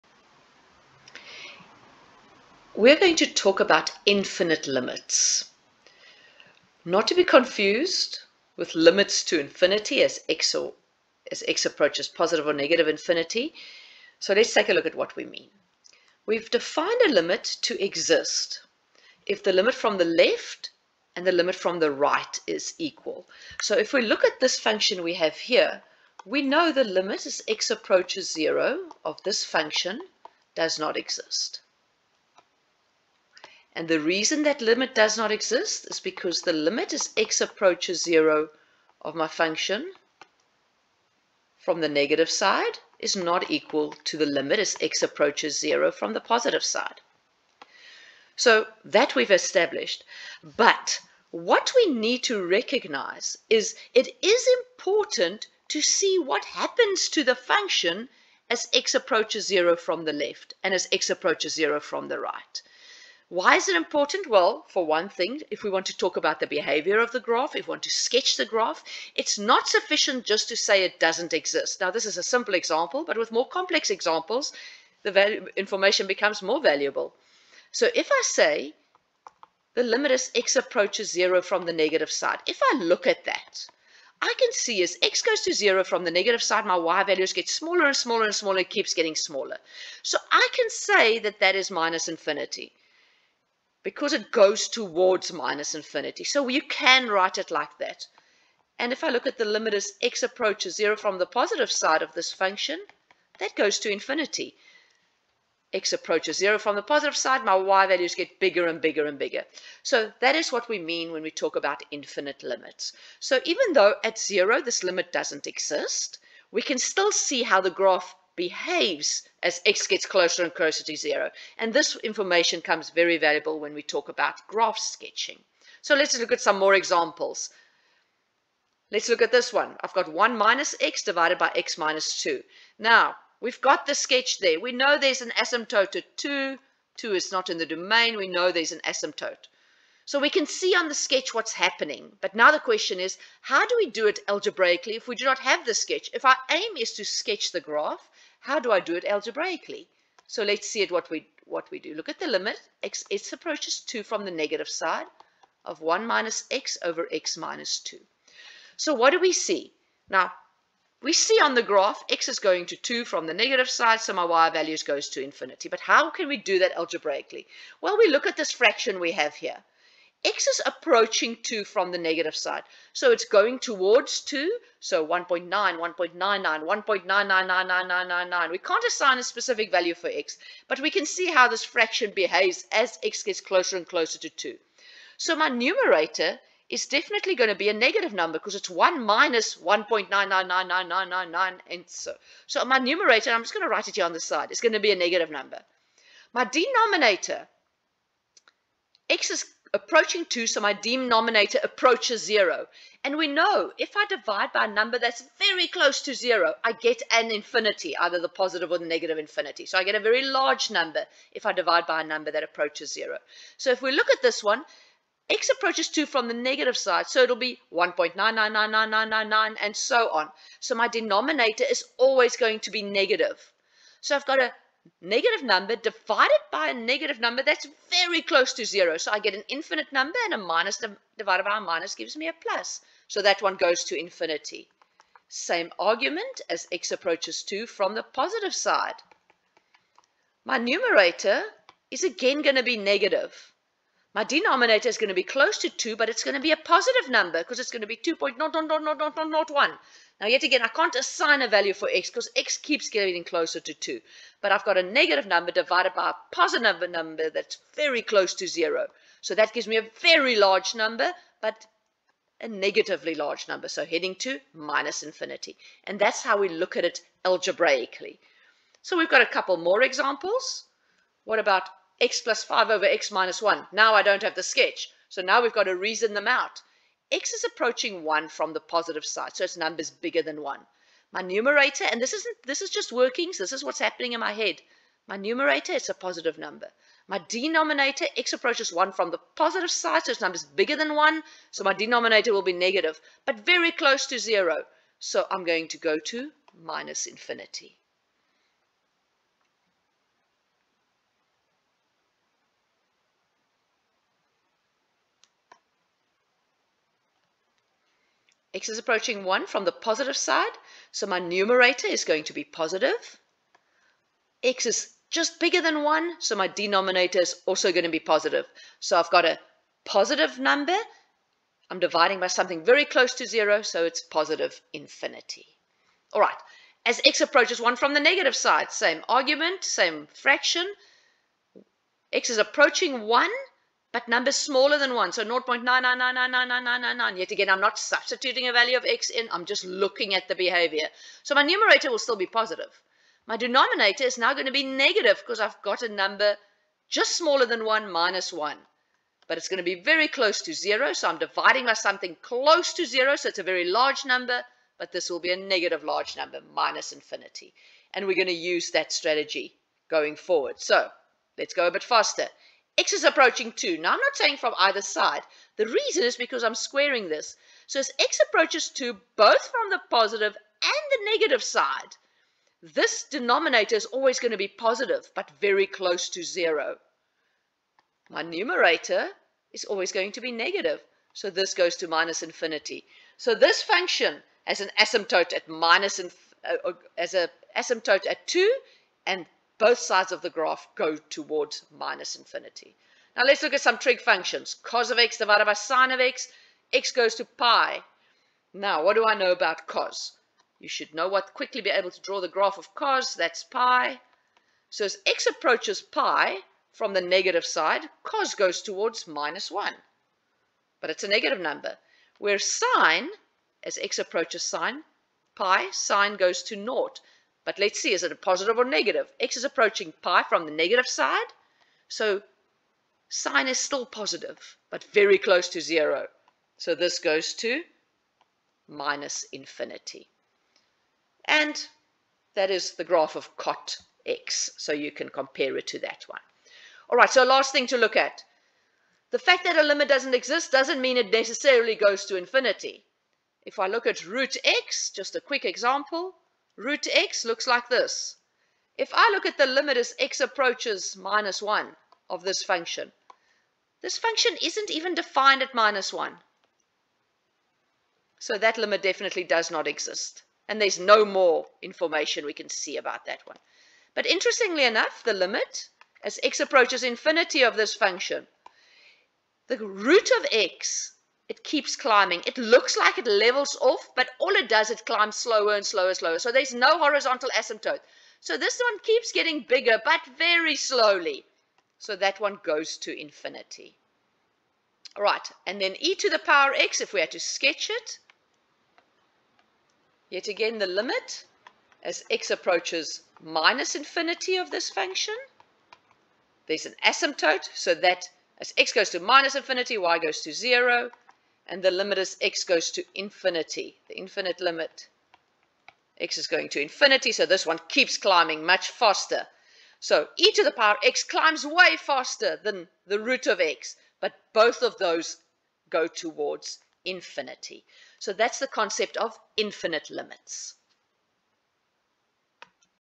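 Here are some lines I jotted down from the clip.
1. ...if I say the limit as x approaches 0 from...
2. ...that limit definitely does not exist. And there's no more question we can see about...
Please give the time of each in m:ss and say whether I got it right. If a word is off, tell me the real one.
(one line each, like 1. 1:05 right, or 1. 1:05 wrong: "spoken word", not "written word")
1. 1:17 right
2. 7:38 wrong: "information", not "question".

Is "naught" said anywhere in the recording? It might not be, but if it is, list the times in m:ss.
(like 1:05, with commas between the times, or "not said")
6:56.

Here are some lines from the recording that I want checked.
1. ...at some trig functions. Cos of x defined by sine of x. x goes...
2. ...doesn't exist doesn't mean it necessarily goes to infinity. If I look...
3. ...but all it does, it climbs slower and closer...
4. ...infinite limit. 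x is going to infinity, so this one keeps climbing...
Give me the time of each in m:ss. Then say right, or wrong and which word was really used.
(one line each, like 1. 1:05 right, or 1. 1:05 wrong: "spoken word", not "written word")
1. 6:33 wrong: "divided", not "defined"
2. 7:19 right
3. 7:53 wrong: "slower", not "closer"
4. 8:23 right.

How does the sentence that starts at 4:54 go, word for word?
So I'm going to go to minus infinity.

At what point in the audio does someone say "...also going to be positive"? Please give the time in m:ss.
5:17.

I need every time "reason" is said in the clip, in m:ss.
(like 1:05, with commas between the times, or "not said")
0:34, 4:35, 6:05.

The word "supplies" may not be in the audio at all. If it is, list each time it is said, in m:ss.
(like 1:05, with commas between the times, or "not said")
not said.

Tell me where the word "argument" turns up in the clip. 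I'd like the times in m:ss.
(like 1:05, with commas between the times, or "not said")
3:55, 5:29.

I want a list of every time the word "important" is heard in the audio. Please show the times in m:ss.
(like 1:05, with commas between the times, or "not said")
0:54, 1:03.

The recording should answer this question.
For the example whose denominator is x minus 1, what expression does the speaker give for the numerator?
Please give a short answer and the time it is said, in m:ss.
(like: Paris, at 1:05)
x plus 5, at 4:32.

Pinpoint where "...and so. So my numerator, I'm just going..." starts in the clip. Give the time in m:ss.
3:11.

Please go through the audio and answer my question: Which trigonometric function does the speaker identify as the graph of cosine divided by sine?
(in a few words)
cot x.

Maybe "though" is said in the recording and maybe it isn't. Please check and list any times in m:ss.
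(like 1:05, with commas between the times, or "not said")
1:53.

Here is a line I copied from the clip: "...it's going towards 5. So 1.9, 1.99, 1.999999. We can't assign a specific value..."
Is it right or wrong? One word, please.
wrong.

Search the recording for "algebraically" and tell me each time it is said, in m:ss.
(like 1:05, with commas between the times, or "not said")
2:24, 2:29, 2:46, 4:27.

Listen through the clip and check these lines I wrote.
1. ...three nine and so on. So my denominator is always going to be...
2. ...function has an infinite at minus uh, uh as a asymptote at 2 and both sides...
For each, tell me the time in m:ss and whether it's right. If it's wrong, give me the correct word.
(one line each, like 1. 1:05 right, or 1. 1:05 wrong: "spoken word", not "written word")
1. 3:39 wrong: "nine", not "three"
2. 6:23 wrong: "asymptote", not "infinite".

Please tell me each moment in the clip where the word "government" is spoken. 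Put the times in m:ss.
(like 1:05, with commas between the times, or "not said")
not said.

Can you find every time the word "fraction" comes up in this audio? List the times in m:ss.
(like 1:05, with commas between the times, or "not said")
2:48, 3:01, 5:30.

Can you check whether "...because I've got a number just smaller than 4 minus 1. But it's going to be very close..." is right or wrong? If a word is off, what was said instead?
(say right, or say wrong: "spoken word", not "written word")
wrong: "1", not "4".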